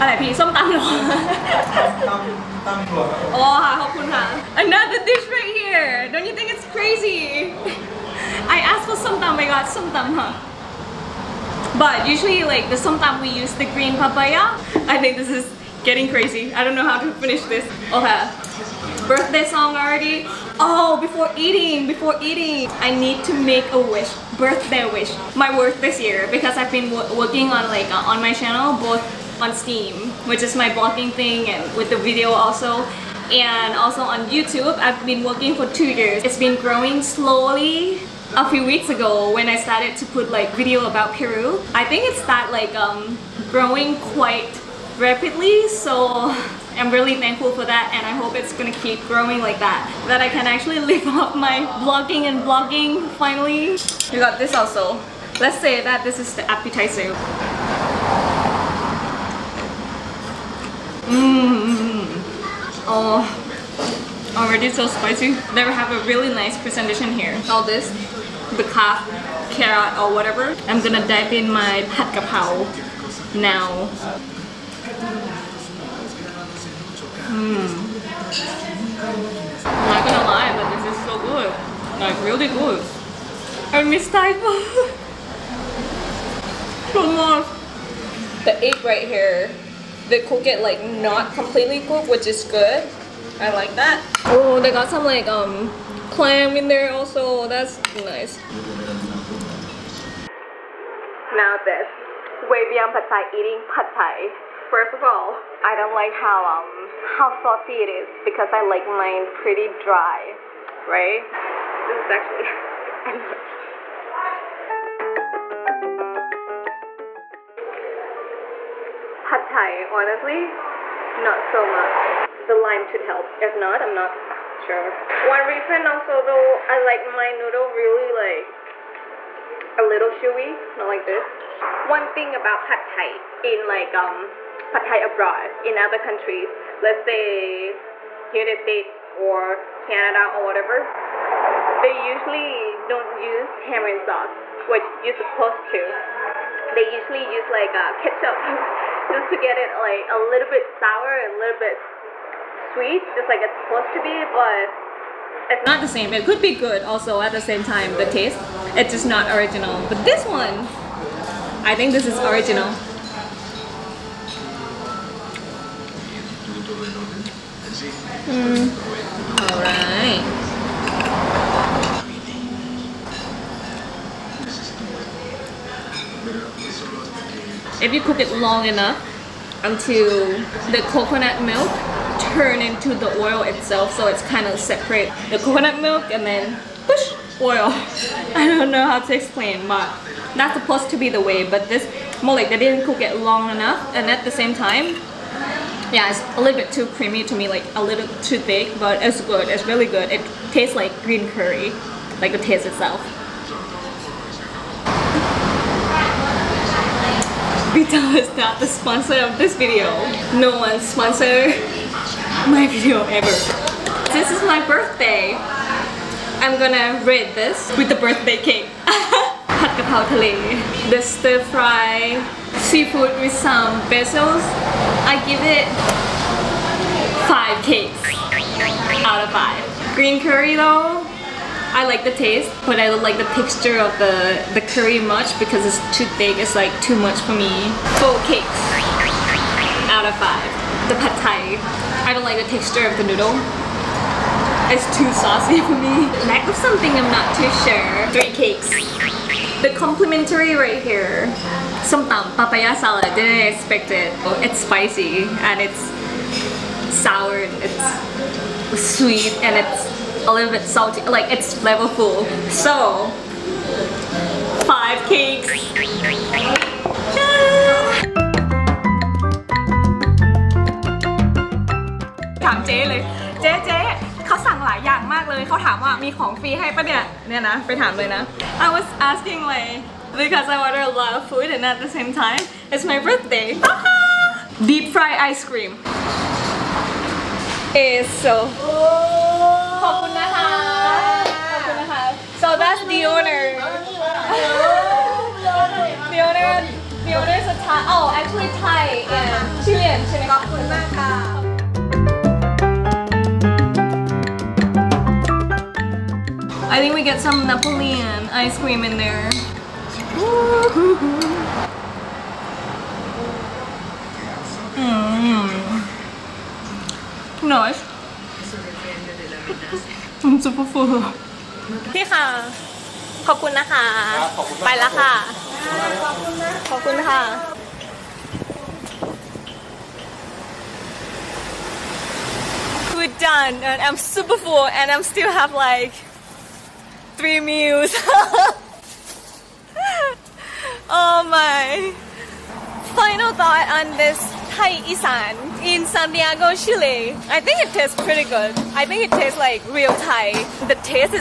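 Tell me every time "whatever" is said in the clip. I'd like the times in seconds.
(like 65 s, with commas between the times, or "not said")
70 s, 140 s.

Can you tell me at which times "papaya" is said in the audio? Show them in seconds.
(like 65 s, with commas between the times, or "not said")
13 s, 252 s.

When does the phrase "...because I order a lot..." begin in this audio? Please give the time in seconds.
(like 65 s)
280 s.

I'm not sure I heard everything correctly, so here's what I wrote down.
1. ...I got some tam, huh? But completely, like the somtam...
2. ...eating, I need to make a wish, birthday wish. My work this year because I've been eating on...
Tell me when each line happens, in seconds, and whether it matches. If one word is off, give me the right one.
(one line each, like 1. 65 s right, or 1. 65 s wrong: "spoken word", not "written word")
1. 9 s wrong: "usually", not "completely"
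2. 22 s wrong: "working", not "eating".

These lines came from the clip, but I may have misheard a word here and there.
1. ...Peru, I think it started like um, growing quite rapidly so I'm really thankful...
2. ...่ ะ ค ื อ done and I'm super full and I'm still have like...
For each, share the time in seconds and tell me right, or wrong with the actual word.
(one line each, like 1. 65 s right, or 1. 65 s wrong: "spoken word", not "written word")
1. 41 s right
2. 327 s right.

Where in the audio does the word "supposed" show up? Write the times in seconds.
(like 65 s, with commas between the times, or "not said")
145 s, 153 s, 190 s.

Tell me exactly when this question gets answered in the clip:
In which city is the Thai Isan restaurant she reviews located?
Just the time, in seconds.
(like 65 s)
345 s.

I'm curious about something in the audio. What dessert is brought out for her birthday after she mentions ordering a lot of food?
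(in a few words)
Deep fried ice cream.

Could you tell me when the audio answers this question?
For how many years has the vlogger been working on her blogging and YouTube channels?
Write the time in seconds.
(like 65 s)
35 s.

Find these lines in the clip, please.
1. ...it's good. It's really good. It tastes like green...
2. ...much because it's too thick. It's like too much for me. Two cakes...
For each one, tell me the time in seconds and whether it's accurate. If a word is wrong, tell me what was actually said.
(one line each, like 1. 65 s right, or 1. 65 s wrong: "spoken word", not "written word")
1. 199 s right
2. 235 s wrong: "Four", not "Two".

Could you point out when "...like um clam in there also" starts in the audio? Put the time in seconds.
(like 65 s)
95 s.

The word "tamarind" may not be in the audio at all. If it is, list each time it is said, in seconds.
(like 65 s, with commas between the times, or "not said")
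143 s.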